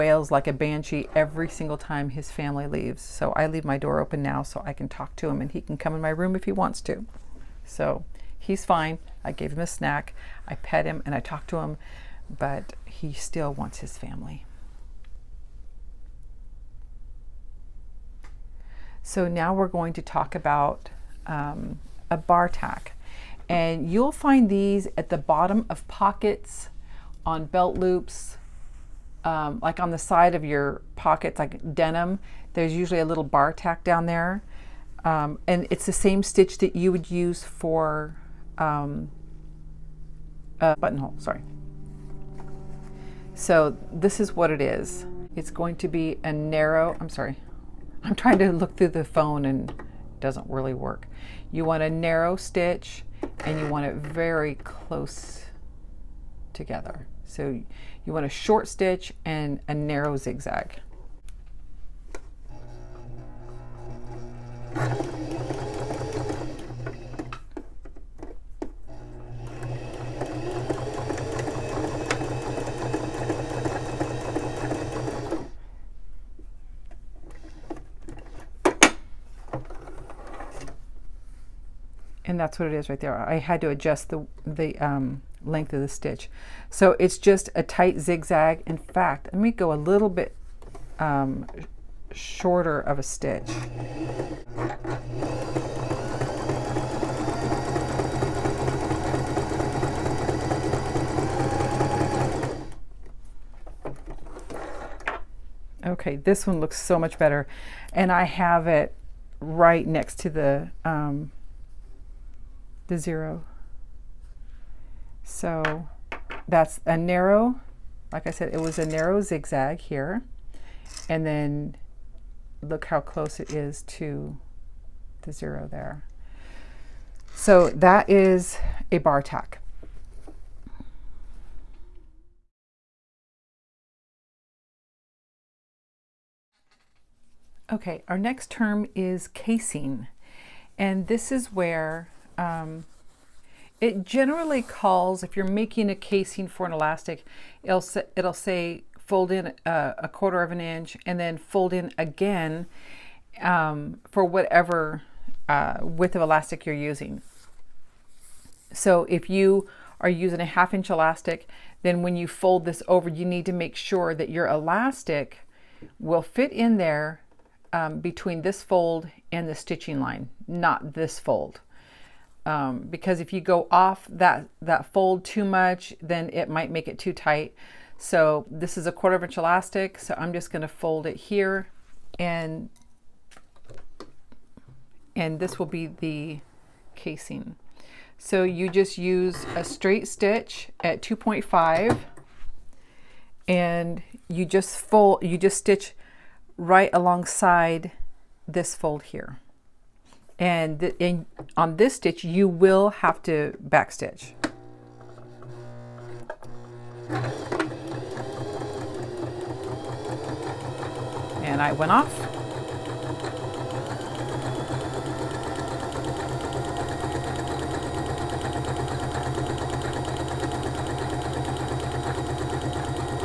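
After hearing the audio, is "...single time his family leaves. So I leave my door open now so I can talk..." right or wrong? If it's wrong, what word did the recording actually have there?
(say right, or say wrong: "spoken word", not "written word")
right.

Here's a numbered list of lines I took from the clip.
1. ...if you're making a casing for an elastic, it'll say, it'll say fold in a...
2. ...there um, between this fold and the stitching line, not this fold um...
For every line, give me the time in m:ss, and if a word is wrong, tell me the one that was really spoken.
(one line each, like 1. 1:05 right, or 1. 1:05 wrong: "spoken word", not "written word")
1. 2:25 right
2. 2:46 right.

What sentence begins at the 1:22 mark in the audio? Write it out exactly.
and that's what it is right there.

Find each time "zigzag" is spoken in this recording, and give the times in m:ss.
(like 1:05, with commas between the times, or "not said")
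1:00, 1:28, 1:59.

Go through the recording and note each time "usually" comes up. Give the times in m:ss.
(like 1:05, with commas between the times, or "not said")
0:32.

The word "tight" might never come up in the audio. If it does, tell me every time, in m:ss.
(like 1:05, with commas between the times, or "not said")
1:27, 2:57.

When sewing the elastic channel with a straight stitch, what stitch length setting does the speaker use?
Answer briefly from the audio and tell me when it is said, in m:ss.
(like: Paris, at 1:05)
2.5, at 3:11.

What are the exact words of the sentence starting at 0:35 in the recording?
Um, and it's the same stitch that you would use for um, a buttonhole, sorry.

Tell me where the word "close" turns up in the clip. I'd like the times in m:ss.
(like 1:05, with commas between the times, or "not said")
0:54, 2:03.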